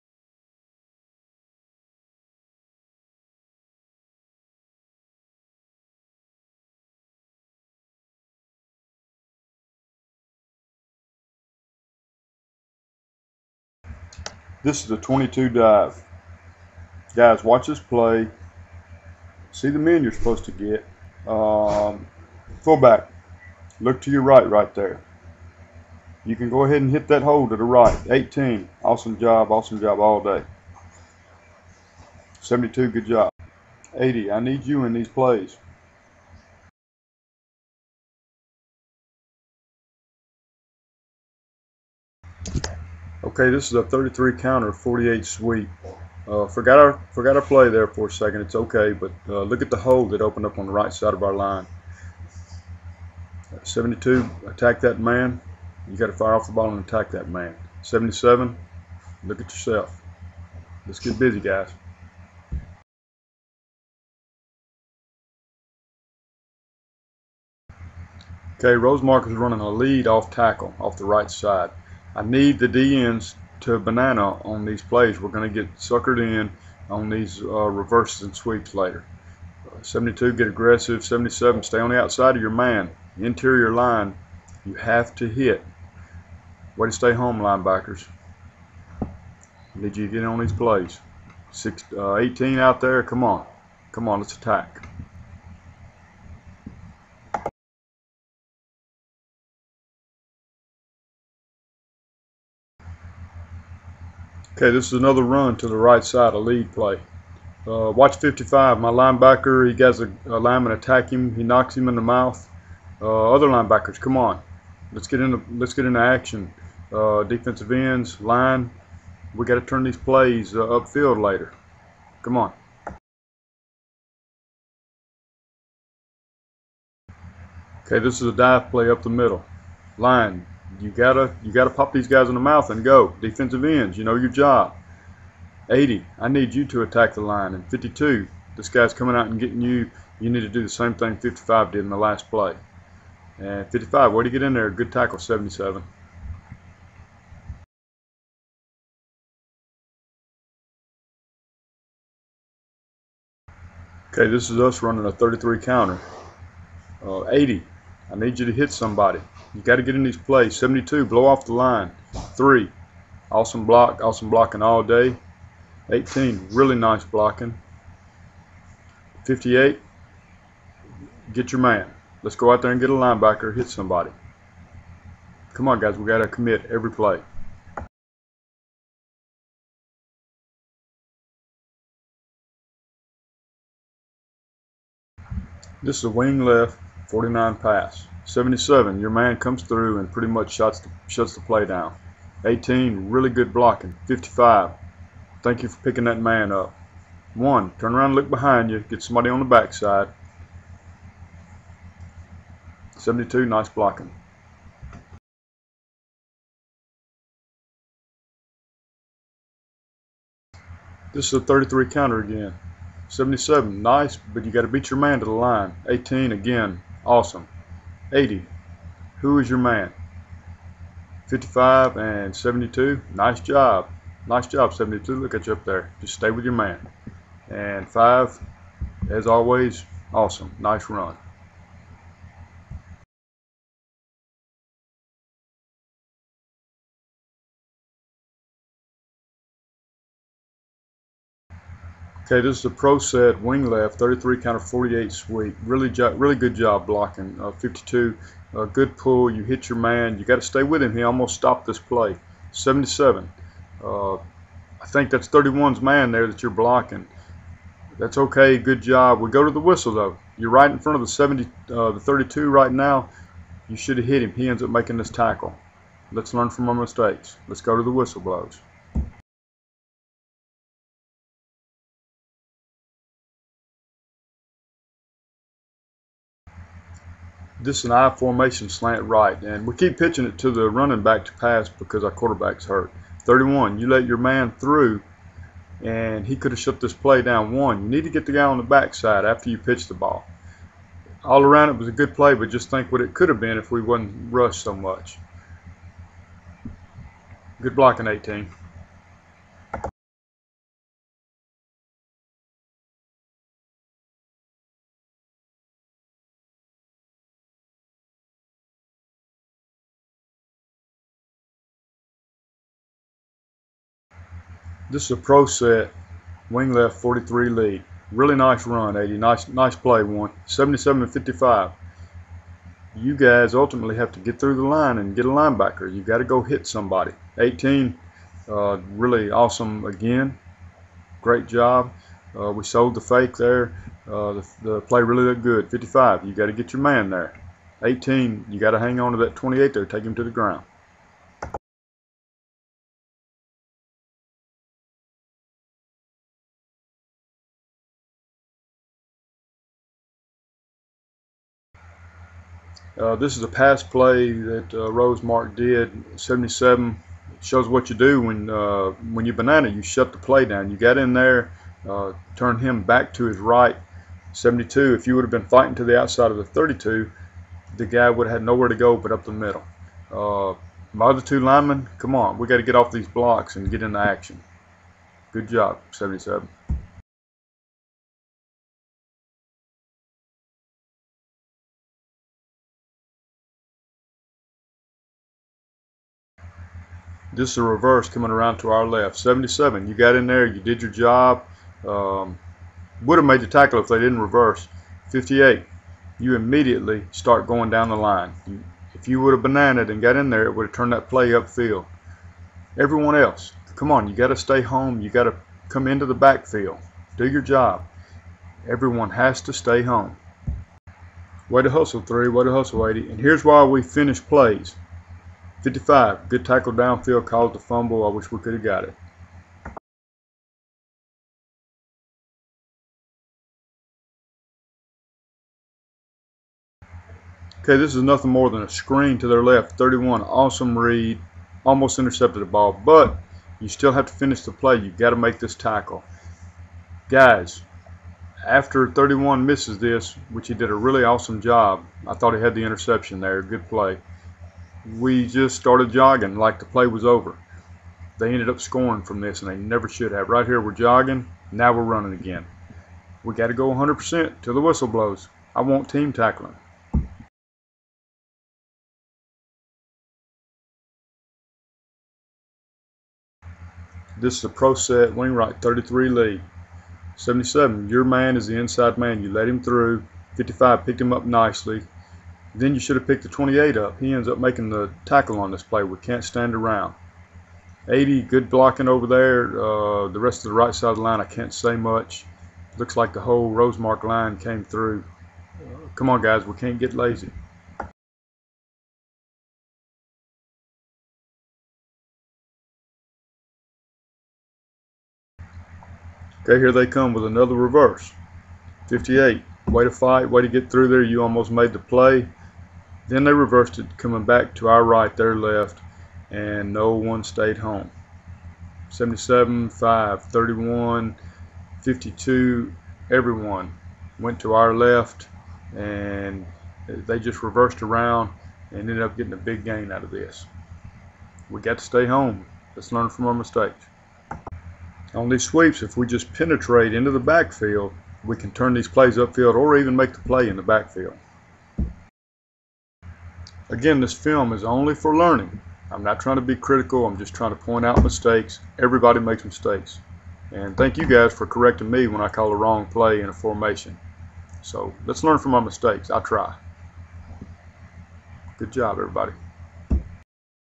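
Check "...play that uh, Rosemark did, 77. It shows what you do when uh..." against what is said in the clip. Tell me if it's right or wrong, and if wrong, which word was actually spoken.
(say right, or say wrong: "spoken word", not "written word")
right.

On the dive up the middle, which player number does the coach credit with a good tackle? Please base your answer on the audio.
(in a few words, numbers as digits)
77.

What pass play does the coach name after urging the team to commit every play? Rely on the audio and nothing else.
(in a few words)
wing left, 49 pass.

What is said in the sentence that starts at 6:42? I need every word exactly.
Everyone else, come on, you got to stay home.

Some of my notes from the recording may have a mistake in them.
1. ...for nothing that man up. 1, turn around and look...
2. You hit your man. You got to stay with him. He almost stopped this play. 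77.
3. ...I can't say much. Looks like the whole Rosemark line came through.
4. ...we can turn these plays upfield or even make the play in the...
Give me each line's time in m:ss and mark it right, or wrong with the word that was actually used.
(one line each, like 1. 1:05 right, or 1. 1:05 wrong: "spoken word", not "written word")
1. 3:15 wrong: "picking", not "nothing"
2. 4:09 right
3. 8:01 right
4. 8:48 right.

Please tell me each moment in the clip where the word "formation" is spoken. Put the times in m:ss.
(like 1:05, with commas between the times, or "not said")
4:38, 9:03.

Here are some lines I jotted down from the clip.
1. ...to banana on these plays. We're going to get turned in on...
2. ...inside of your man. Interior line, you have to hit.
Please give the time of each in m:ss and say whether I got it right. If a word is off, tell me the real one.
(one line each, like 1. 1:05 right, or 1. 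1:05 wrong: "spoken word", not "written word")
1. 1:13 wrong: "suckered", not "turned"
2. 1:22 wrong: "outside", not "inside".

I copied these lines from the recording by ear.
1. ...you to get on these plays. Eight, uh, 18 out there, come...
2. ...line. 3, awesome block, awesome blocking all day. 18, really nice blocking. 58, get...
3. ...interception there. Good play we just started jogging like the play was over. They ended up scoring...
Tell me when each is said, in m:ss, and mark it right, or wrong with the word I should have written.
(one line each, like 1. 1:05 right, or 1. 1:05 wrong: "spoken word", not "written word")
1. 1:29 wrong: "Six", not "Eight"
2. 2:41 right
3. 7:22 right.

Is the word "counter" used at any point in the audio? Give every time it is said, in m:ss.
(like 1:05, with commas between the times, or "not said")
0:44, 2:35, 3:31, 4:04.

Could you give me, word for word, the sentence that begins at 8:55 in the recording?
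I'm not trying to be critical.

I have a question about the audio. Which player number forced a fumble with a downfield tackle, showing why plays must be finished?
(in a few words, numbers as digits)
55.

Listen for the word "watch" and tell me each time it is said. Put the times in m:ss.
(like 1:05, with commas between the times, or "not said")
0:17, 1:47.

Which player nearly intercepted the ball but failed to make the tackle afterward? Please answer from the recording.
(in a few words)
31.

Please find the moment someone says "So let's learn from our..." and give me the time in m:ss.
9:04.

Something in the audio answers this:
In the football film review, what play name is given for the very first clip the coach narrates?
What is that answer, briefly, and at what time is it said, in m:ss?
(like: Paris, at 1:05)
22 dive, at 0:14.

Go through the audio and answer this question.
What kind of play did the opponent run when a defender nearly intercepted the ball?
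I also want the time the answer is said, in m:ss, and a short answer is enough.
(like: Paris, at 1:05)
A screen, at 7:08.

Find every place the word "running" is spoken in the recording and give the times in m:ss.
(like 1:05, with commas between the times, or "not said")
1:09, 2:34, 4:40, 7:31.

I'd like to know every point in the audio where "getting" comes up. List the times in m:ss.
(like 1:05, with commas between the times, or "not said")
2:19, 8:39.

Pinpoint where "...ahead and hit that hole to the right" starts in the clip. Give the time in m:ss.
0:26.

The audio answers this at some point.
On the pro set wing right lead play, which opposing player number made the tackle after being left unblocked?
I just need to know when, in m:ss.
7:53.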